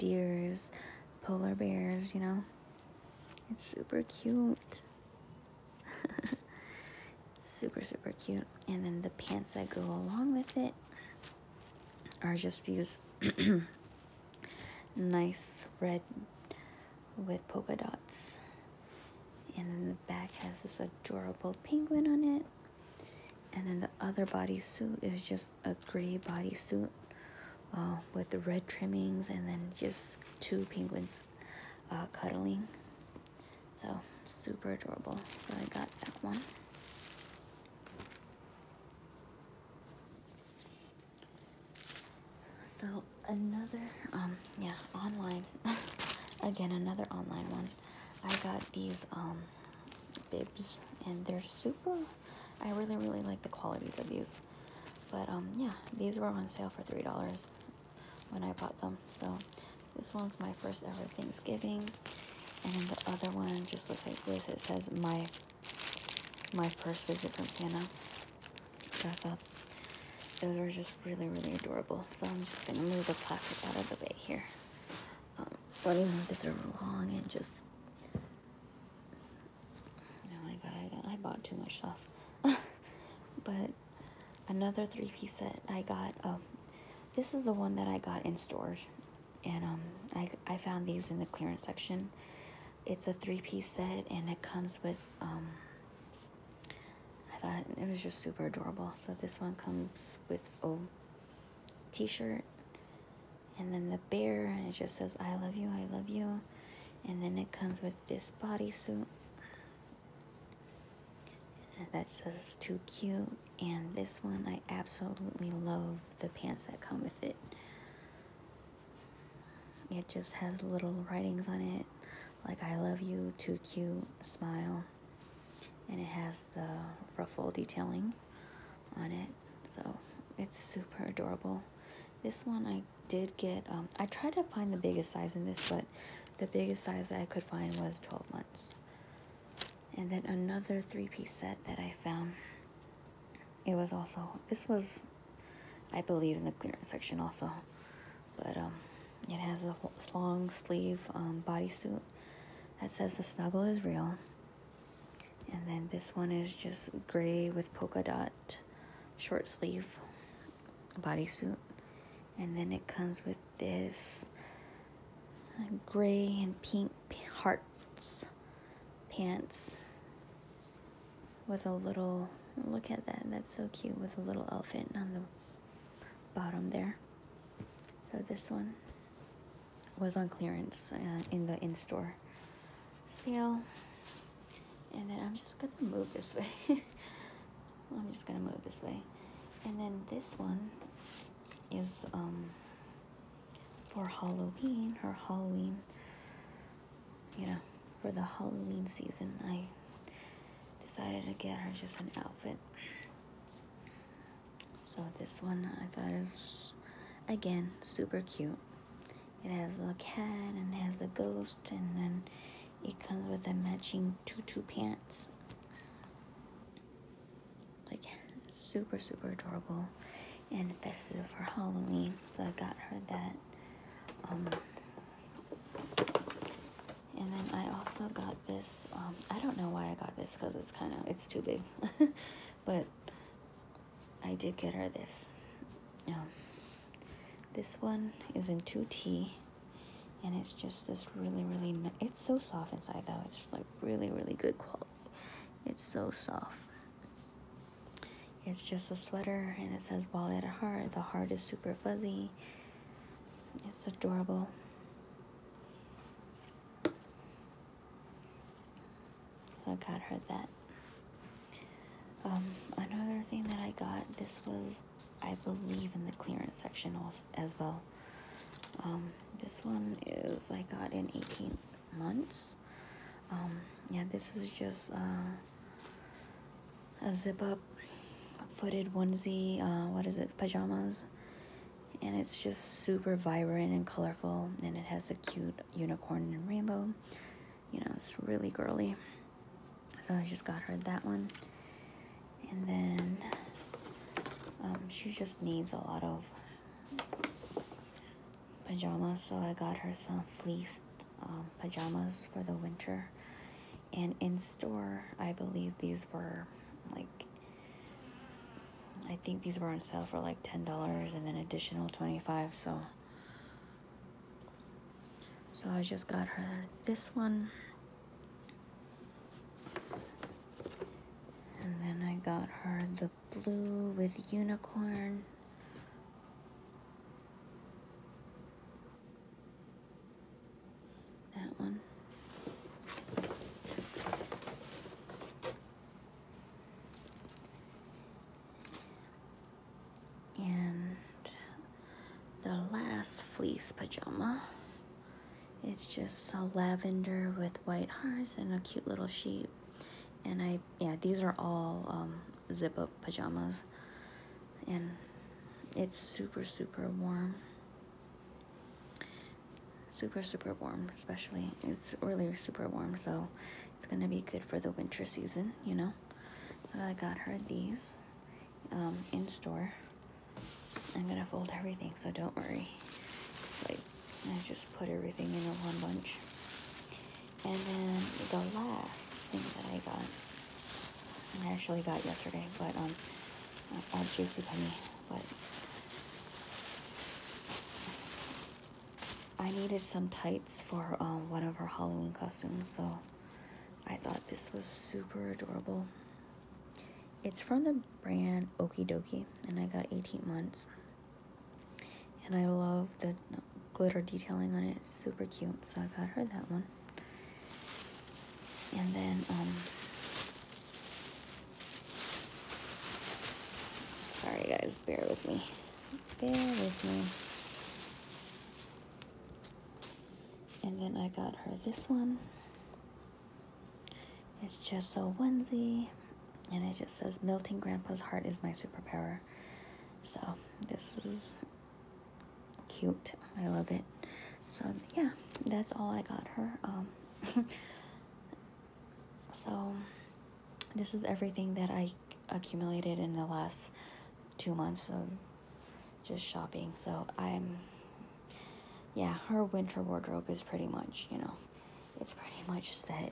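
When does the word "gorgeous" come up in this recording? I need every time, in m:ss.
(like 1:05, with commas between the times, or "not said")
not said.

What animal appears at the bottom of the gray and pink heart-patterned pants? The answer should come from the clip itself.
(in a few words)
elephant.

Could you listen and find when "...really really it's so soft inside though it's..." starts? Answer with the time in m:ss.
4:01.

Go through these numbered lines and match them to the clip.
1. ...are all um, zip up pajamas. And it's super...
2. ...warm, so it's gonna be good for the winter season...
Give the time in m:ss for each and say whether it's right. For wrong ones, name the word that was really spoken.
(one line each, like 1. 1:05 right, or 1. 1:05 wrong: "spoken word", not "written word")
1. 5:51 right
2. 6:02 right.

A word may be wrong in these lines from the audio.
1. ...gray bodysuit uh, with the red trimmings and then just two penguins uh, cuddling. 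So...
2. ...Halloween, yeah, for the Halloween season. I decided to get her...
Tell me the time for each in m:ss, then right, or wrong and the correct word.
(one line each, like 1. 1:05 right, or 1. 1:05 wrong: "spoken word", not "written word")
1. 0:25 right
2. 3:15 right.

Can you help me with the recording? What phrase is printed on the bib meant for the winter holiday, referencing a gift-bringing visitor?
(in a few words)
my first visit from Santa.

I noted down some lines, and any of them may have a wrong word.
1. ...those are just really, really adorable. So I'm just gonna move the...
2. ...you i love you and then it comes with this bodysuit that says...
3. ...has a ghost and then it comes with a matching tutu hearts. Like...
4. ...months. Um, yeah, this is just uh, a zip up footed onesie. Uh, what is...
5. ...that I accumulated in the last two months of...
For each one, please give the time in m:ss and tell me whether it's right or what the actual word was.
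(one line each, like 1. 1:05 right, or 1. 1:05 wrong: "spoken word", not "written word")
1. 1:10 right
2. 1:45 right
3. 3:30 wrong: "pants", not "hearts"
4. 4:31 right
5. 7:21 right.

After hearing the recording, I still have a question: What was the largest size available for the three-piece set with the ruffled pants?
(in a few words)
12 months.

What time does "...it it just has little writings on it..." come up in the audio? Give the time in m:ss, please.
1:57.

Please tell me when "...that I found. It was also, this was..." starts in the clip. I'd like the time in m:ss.
2:21.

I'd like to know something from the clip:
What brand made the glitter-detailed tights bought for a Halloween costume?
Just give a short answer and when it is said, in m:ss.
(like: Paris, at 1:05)
Okie Dokie, at 6:38.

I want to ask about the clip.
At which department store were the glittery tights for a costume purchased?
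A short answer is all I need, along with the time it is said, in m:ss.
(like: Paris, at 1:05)
JCPenney, at 6:24.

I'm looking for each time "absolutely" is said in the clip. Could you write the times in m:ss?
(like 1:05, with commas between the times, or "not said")
1:54.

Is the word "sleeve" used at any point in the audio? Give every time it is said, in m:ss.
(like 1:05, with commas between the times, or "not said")
2:30, 2:39.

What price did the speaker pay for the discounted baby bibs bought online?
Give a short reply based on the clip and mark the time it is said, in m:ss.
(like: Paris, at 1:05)
$3, at 0:56.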